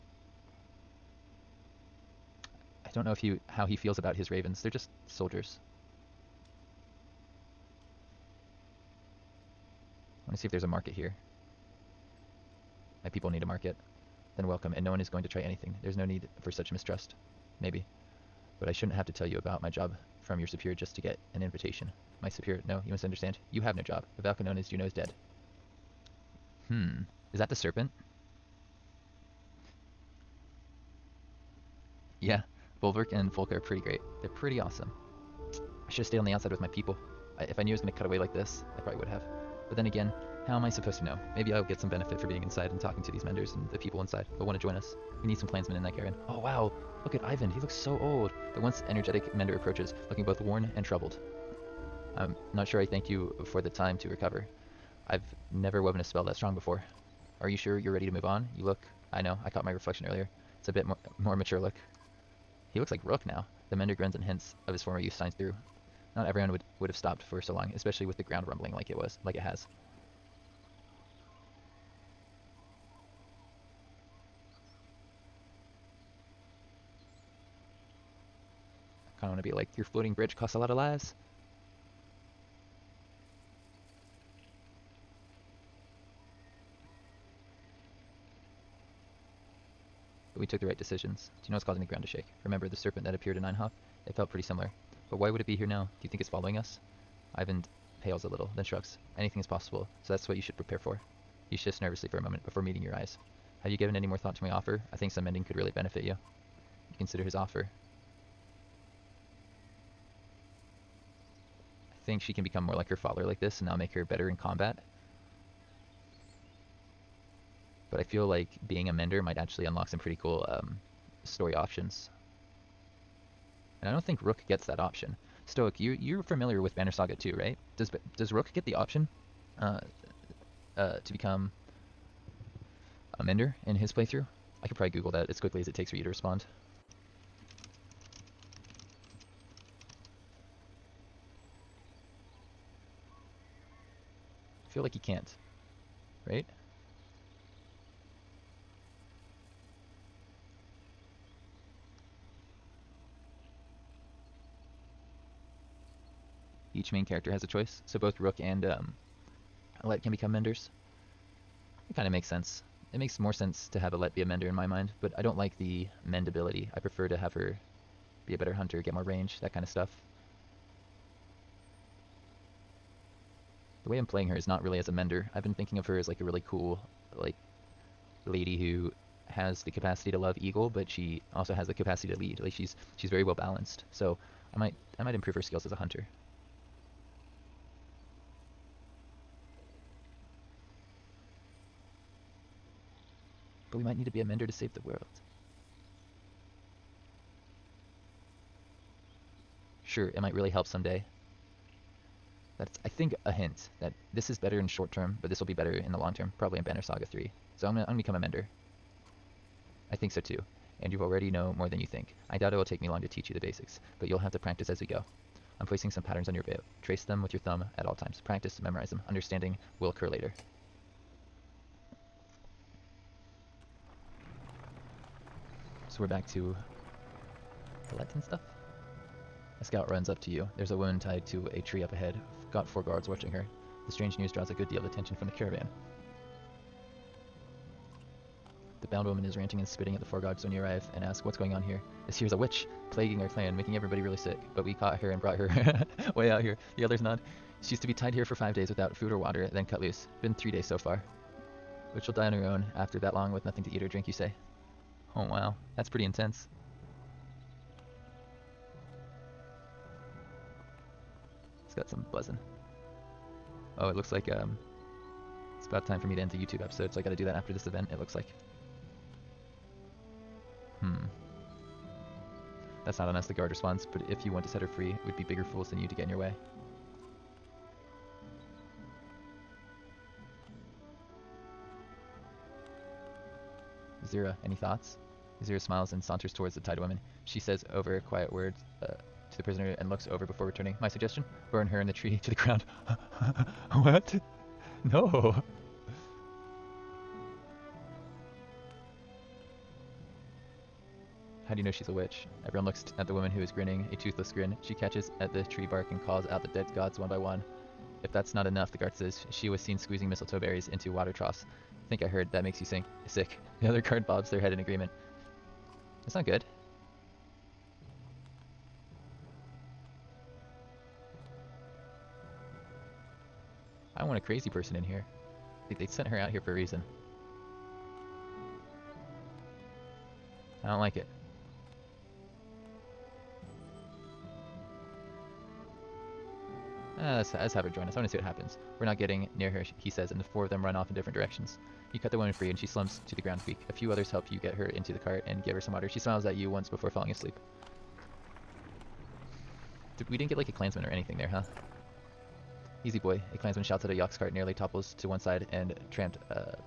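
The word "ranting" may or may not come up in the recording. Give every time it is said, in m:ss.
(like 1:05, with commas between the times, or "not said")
3:59.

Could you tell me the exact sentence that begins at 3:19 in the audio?
sure it might really help someday.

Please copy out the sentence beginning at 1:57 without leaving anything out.
but I feel like being a mender might actually unlock some pretty cool um, story options.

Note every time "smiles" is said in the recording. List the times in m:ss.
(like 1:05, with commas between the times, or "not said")
4:45, 5:45.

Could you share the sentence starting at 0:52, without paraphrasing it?
I'm not sure I thank you for the time to recover.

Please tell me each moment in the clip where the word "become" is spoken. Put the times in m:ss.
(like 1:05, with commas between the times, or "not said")
1:52, 2:11, 2:40, 3:27.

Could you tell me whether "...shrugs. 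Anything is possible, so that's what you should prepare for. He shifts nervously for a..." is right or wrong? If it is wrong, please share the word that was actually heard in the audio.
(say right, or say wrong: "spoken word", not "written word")
right.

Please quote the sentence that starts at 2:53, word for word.
The way I'm playing her is not really as a mender.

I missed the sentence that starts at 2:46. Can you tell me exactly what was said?
I prefer to have her be a better hunter, get more range, that kind of stuff.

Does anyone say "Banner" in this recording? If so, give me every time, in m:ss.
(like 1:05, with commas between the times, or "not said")
2:06, 3:26.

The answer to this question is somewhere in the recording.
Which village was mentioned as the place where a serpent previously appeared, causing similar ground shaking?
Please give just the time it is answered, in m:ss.
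1:33.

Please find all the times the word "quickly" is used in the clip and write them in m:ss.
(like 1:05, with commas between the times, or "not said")
2:15.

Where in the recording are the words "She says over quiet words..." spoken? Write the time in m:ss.
4:47.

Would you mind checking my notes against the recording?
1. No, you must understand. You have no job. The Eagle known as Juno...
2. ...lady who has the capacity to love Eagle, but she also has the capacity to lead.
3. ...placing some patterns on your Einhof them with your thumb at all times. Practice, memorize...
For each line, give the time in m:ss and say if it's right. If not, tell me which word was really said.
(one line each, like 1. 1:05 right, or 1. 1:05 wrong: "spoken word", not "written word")
1. 0:22 wrong: "Valka", not "Eagle"
2. 2:58 right
3. 3:35 wrong: "Trace", not "Einhof".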